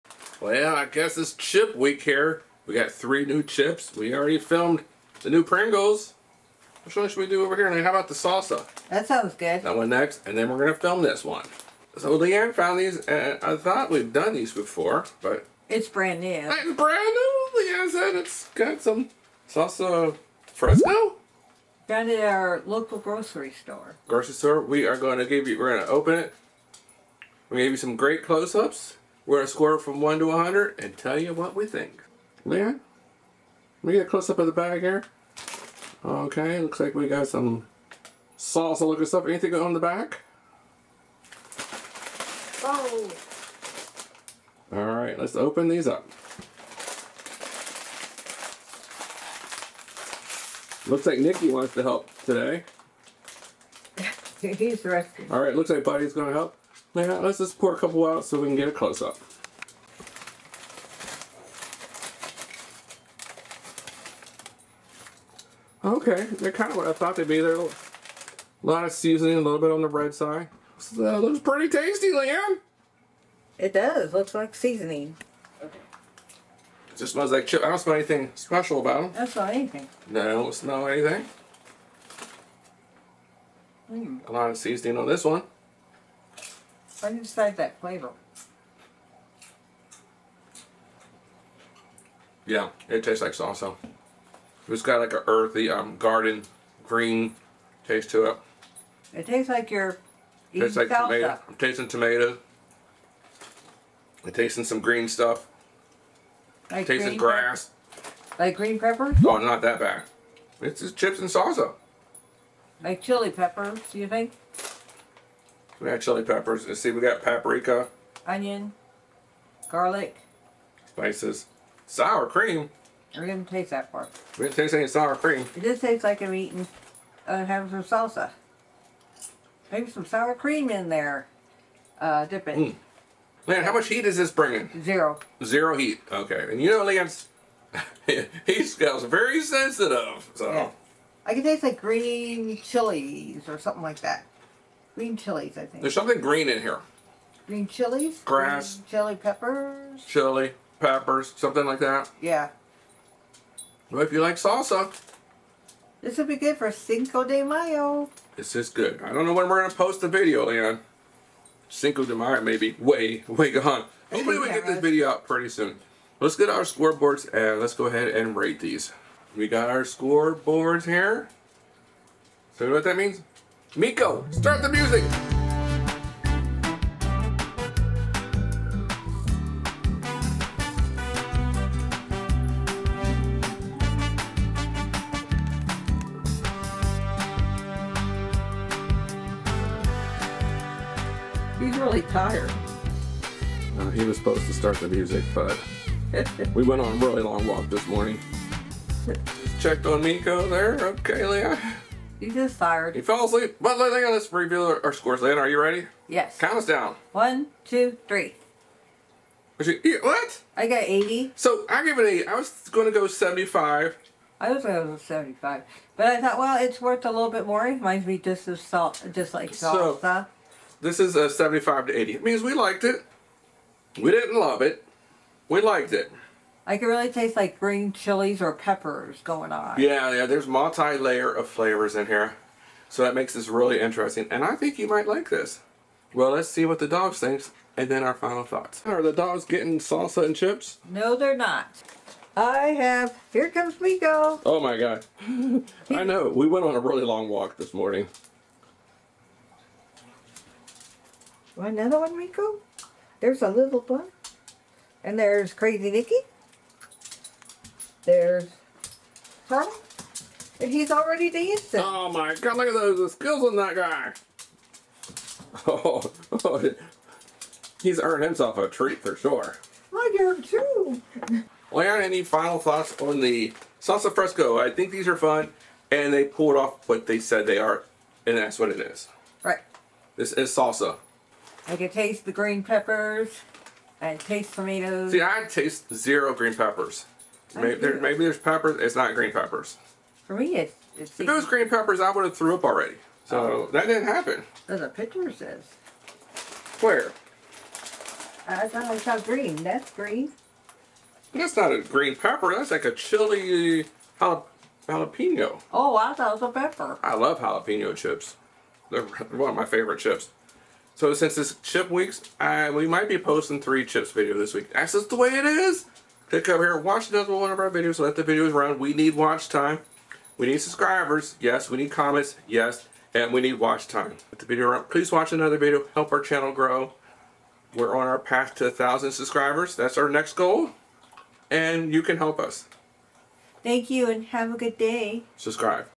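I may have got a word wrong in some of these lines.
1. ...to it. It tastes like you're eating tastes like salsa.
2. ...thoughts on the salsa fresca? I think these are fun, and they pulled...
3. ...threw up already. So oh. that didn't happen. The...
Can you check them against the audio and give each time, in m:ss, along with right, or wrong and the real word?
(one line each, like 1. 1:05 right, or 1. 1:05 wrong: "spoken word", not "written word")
1. 1:38 right
2. 4:32 right
3. 4:52 right.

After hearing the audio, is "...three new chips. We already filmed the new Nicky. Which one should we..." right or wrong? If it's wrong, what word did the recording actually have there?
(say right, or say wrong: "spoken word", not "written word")
wrong: "Pringles", not "Nicky".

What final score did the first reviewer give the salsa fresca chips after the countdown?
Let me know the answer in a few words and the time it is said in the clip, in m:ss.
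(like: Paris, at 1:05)
80, at 3:30.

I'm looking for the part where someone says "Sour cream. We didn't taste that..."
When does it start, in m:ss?
2:01.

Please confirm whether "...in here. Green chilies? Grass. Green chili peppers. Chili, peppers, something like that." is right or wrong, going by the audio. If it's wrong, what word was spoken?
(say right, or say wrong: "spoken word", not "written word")
right.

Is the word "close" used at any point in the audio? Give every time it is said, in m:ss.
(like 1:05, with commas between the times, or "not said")
0:28, 0:34, 0:58.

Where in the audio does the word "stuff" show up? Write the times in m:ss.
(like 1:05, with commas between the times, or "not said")
0:39, 1:45.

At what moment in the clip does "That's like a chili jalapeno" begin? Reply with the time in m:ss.
5:02.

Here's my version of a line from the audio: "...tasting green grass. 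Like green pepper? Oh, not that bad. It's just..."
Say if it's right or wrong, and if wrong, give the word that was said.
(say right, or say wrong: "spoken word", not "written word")
right.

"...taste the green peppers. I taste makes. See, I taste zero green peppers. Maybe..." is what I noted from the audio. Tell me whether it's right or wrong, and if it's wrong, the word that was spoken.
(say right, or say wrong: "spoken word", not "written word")
wrong: "tomatoes", not "makes".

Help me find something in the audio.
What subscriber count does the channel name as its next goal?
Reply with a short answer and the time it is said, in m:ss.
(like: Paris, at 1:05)
1,000, at 5:28.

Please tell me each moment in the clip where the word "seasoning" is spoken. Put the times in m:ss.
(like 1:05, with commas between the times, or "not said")
1:08, 1:14, 1:24.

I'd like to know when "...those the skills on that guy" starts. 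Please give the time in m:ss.
4:22.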